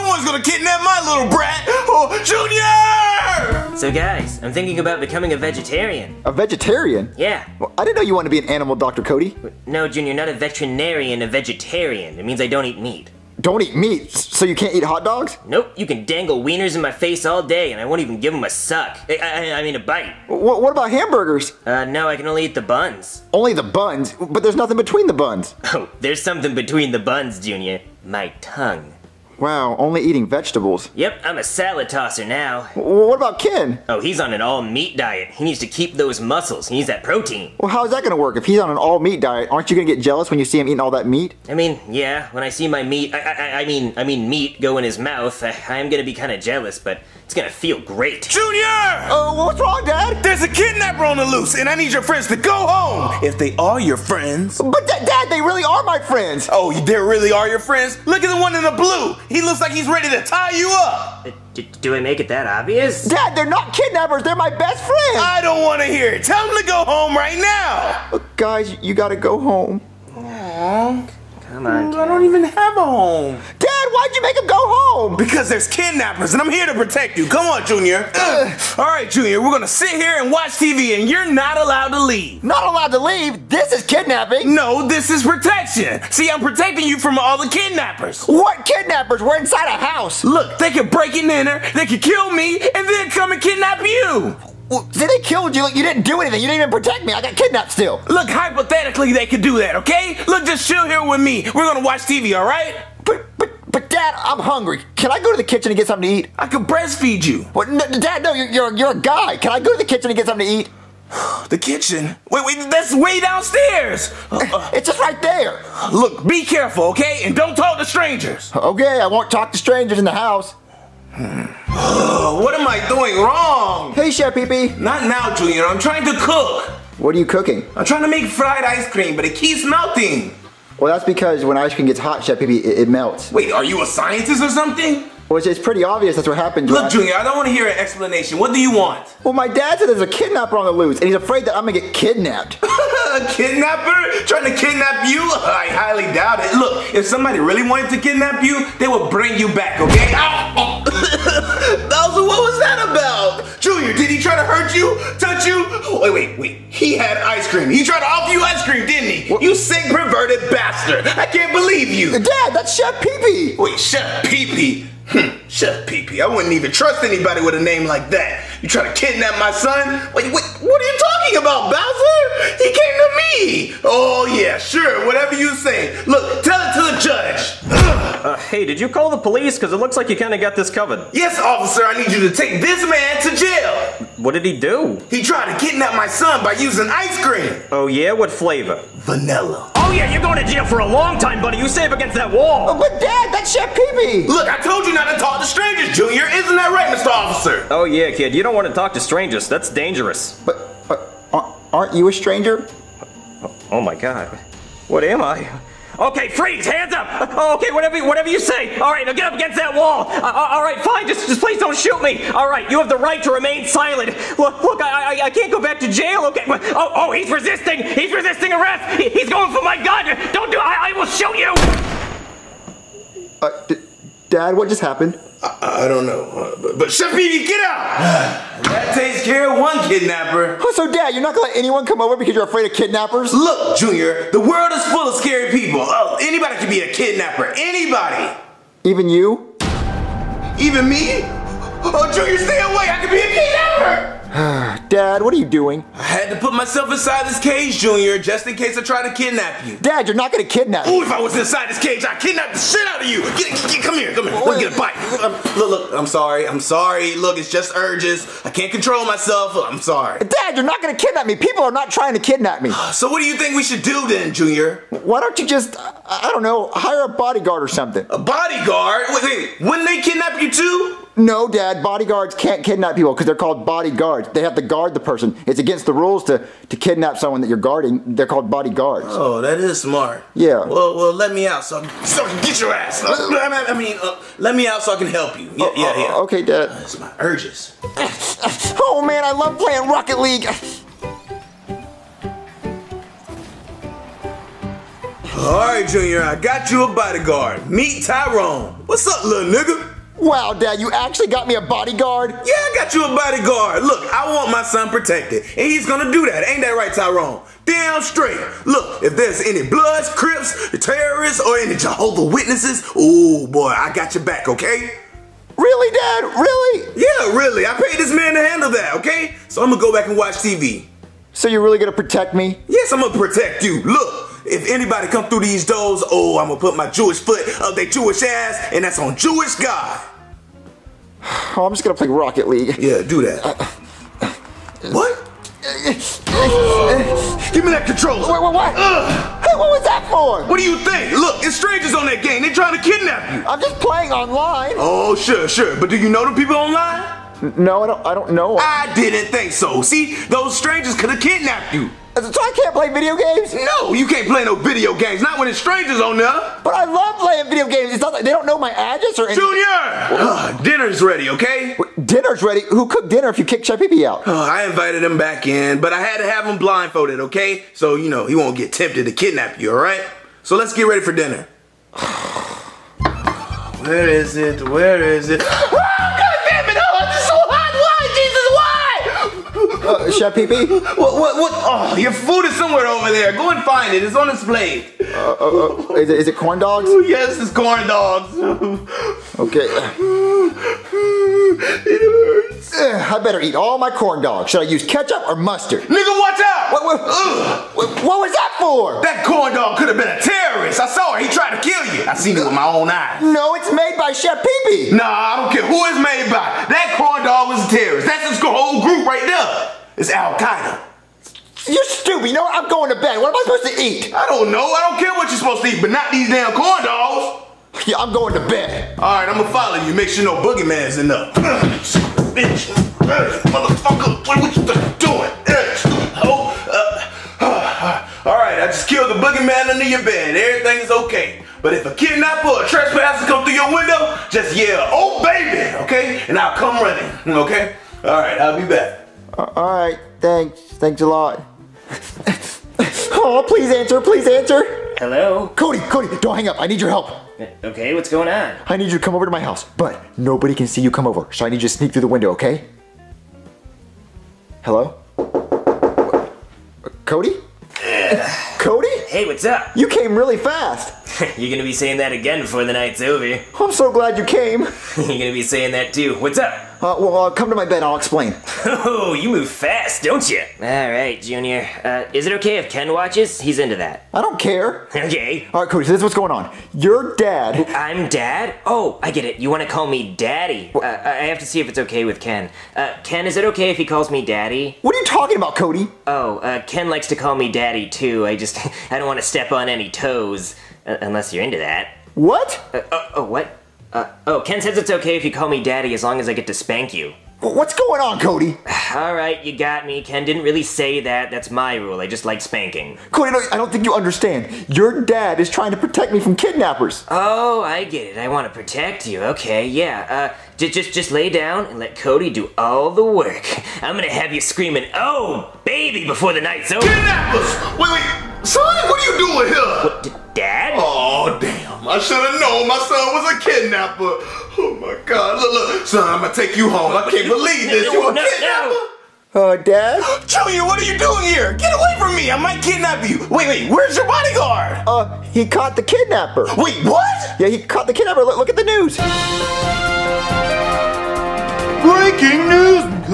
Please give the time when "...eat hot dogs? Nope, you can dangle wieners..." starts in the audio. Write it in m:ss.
0:14.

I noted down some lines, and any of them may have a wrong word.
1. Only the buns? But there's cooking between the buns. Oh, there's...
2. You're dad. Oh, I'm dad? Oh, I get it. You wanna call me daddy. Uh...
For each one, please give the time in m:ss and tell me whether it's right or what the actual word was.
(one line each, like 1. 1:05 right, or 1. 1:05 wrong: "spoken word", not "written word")
1. 0:23 wrong: "nothing", not "cooking"
2. 7:56 right.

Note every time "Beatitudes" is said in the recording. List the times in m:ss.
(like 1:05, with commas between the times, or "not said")
not said.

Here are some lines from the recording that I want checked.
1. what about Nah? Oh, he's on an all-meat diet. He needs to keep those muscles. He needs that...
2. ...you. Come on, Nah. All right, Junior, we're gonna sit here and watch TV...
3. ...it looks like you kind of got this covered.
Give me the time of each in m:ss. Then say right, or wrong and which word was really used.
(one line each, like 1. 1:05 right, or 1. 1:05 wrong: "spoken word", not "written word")
1. 0:32 wrong: "Ken", not "Nah"
2. 1:17 wrong: "Junior", not "Nah"
3. 2:59 right.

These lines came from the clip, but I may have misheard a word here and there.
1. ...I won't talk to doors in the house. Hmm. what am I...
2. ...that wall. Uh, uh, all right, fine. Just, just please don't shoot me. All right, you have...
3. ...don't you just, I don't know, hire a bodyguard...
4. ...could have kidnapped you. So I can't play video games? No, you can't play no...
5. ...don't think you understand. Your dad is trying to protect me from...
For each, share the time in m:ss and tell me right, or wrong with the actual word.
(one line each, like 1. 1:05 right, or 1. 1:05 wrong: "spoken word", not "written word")
1. 1:58 wrong: "strangers", not "doors"
2. 3:29 right
3. 4:25 right
4. 5:50 right
5. 8:23 right.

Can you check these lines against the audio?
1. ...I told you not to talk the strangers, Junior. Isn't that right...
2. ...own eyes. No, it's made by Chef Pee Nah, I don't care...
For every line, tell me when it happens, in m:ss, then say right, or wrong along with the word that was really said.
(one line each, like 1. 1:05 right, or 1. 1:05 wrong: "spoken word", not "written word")
1. 3:14 right
2. 6:42 right.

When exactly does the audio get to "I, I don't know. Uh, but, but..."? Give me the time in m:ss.
3:45.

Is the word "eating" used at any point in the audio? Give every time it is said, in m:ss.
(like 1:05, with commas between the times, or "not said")
0:30, 0:40.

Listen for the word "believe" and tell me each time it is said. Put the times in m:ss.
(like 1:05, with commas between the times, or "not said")
2:41, 8:47.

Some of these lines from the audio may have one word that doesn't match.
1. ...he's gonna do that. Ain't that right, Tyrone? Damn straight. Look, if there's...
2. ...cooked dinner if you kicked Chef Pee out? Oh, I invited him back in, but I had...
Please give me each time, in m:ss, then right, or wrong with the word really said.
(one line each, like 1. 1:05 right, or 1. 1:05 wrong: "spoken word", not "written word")
1. 5:05 right
2. 6:02 right.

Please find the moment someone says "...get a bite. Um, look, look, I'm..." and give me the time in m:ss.
4:14.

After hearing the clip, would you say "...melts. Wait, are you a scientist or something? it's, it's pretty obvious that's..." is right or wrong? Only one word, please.
right.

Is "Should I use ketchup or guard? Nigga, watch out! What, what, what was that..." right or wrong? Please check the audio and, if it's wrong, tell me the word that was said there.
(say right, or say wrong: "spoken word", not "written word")
wrong: "mustard", not "guard".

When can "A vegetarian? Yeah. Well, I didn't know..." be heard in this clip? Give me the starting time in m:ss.
0:06.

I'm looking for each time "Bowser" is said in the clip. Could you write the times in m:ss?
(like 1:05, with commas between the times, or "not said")
2:31, 2:51.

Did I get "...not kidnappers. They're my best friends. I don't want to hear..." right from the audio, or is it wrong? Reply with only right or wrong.
right.